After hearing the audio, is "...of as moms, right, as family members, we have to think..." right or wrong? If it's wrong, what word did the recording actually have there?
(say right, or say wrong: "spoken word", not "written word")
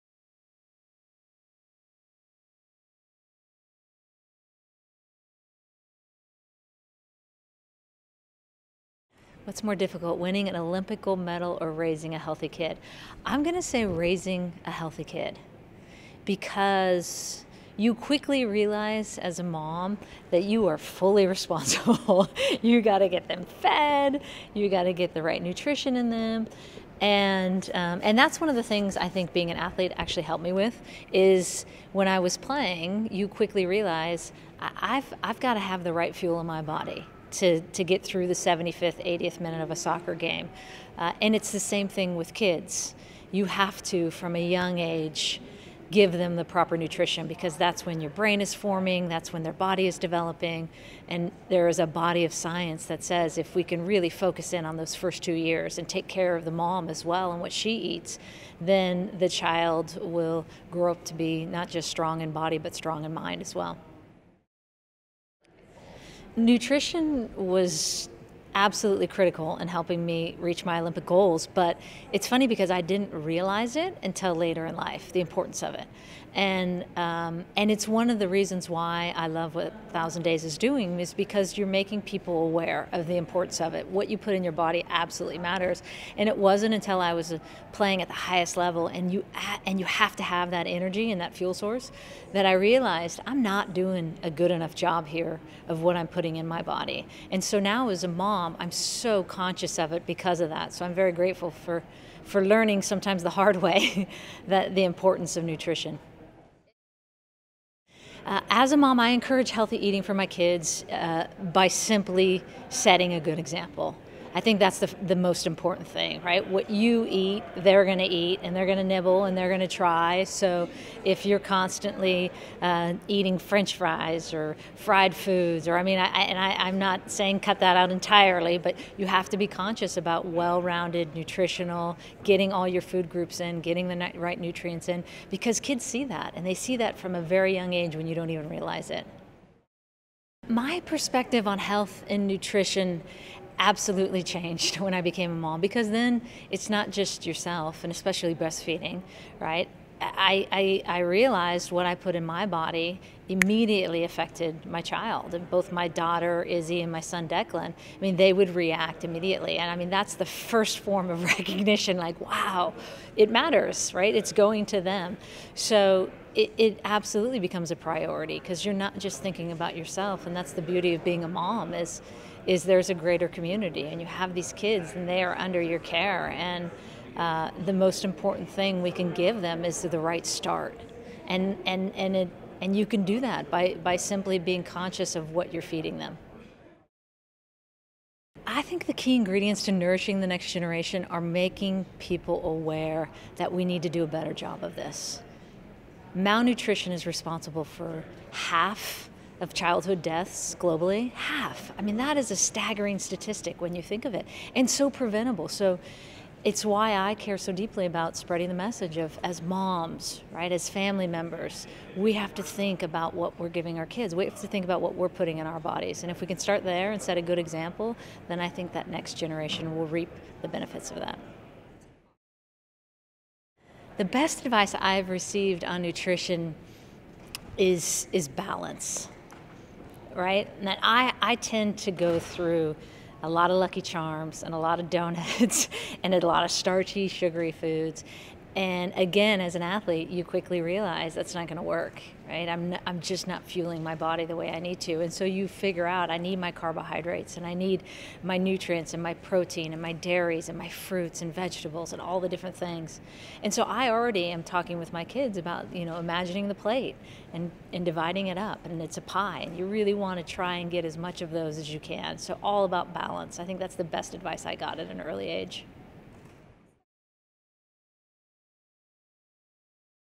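right.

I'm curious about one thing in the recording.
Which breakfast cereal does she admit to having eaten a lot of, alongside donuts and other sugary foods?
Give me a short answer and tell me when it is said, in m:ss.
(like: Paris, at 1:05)
Lucky Charms, at 3:53.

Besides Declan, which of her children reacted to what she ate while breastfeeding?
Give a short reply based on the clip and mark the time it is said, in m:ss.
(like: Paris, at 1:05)
Izzy, at 2:36.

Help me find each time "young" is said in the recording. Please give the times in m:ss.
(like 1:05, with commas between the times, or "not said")
0:44, 2:17.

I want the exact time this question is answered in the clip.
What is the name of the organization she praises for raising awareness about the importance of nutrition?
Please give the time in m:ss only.
1:19.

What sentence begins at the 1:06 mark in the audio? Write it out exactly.
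Nutrition was absolutely critical in helping me reach my Olympic goals.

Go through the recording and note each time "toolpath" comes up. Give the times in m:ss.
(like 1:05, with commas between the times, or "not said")
not said.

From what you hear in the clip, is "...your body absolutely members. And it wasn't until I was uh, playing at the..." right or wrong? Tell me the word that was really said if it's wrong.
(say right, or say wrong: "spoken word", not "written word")
wrong: "matters", not "members".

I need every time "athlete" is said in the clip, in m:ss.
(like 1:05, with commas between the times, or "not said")
0:29, 3:59.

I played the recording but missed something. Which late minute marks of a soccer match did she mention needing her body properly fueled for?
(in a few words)
75th, 80th minute.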